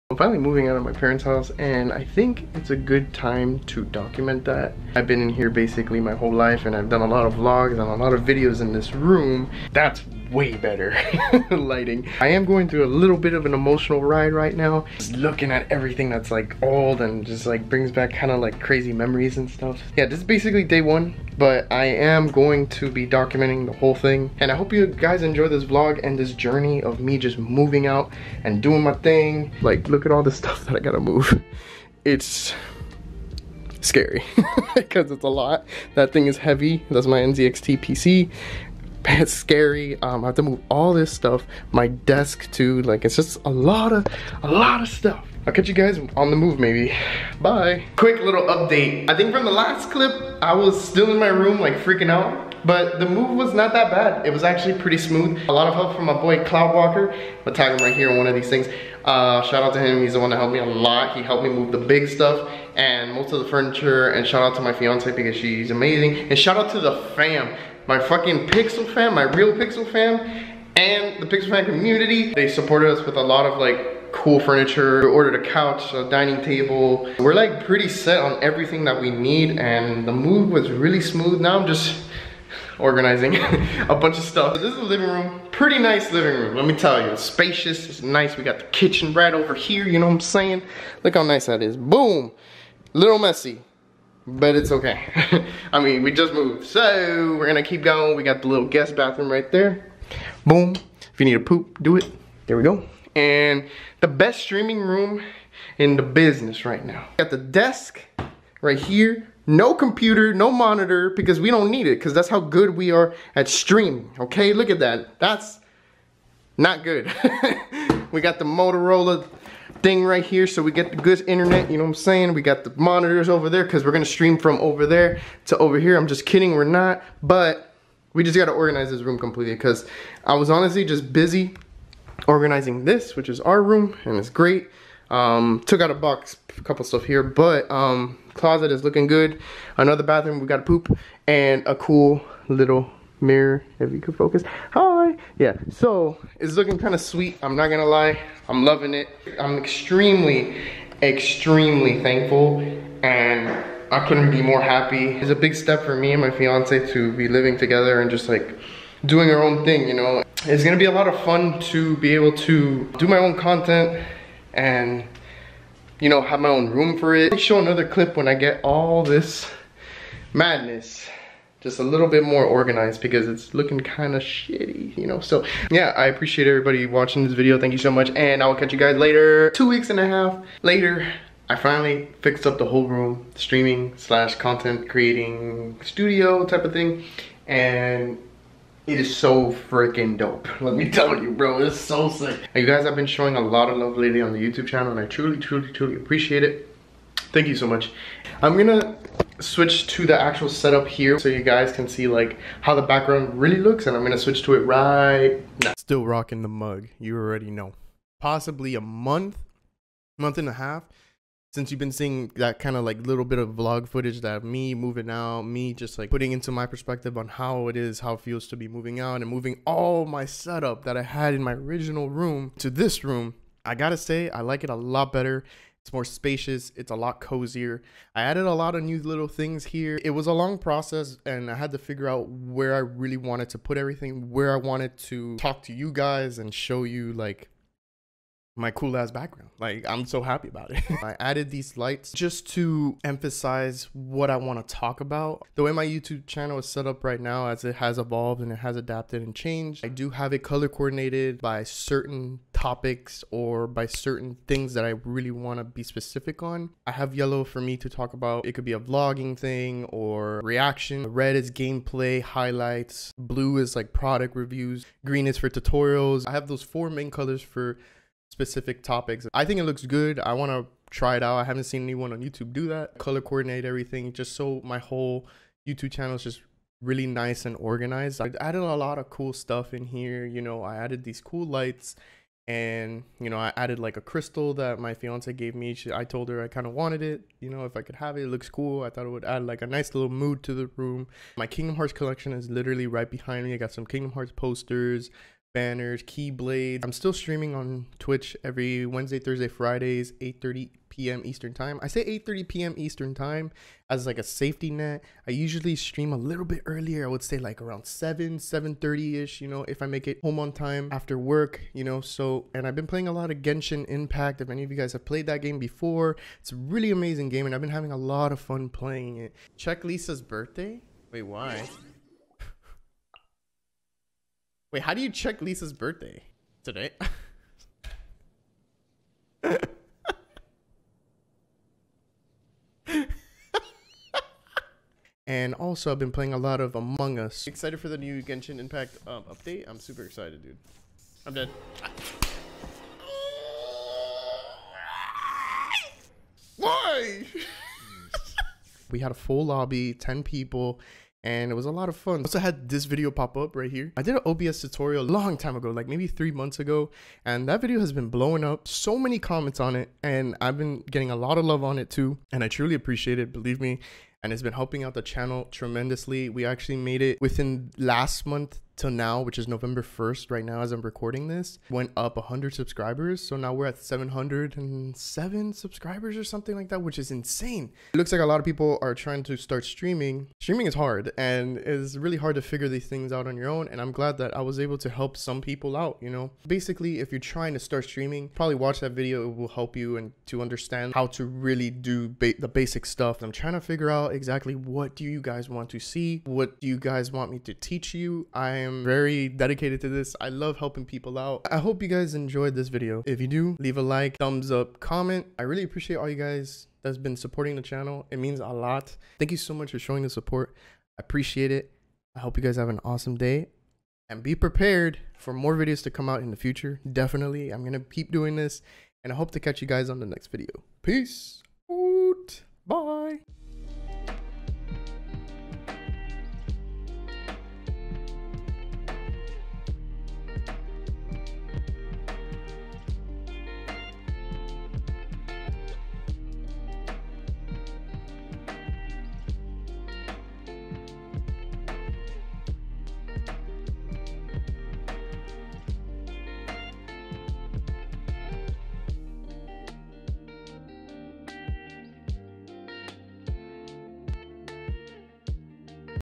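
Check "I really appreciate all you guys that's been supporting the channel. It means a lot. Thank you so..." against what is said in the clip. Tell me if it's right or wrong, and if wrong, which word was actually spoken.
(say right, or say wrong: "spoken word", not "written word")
right.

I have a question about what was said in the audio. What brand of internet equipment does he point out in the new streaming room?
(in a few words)
Motorola.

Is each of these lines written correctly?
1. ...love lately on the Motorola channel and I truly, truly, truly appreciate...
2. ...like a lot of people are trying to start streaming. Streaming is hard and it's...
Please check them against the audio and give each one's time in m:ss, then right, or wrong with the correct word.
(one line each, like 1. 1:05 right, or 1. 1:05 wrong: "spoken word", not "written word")
1. 3:13 wrong: "YouTube", not "Motorola"
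2. 6:18 right.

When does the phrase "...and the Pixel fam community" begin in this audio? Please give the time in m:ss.
1:10.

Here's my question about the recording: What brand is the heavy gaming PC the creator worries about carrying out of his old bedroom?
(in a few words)
NZXT.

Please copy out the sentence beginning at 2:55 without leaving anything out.
So yeah, I appreciate everybody watching this video.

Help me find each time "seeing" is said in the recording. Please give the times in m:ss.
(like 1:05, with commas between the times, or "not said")
3:31.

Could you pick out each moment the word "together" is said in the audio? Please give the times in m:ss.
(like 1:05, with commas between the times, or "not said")
2:37.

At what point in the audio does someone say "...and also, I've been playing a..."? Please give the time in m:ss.
5:35.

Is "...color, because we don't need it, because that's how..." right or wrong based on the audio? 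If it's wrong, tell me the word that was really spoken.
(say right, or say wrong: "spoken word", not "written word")
wrong: "monitor", not "color".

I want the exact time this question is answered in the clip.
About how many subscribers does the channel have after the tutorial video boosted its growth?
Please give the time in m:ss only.
6:13.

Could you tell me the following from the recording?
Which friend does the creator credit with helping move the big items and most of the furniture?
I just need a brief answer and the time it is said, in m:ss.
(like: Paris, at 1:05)
Cloud Walker, at 0:56.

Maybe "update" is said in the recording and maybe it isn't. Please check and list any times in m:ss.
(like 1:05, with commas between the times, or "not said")
0:48, 5:39.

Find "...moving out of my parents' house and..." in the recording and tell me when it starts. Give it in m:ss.
0:00.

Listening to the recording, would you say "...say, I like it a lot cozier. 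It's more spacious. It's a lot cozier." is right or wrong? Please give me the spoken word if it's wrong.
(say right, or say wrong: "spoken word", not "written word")
wrong: "better", not "cozier".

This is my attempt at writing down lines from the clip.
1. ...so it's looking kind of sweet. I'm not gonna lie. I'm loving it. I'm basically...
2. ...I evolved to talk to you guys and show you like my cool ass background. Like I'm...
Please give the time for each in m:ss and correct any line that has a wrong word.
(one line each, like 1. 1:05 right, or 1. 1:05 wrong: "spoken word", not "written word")
1. 2:25 wrong: "extremely", not "basically"
2. 3:54 wrong: "wanted", not "evolved".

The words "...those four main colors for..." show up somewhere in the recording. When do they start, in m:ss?
4:26.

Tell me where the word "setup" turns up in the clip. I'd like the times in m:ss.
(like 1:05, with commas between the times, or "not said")
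3:20, 3:40.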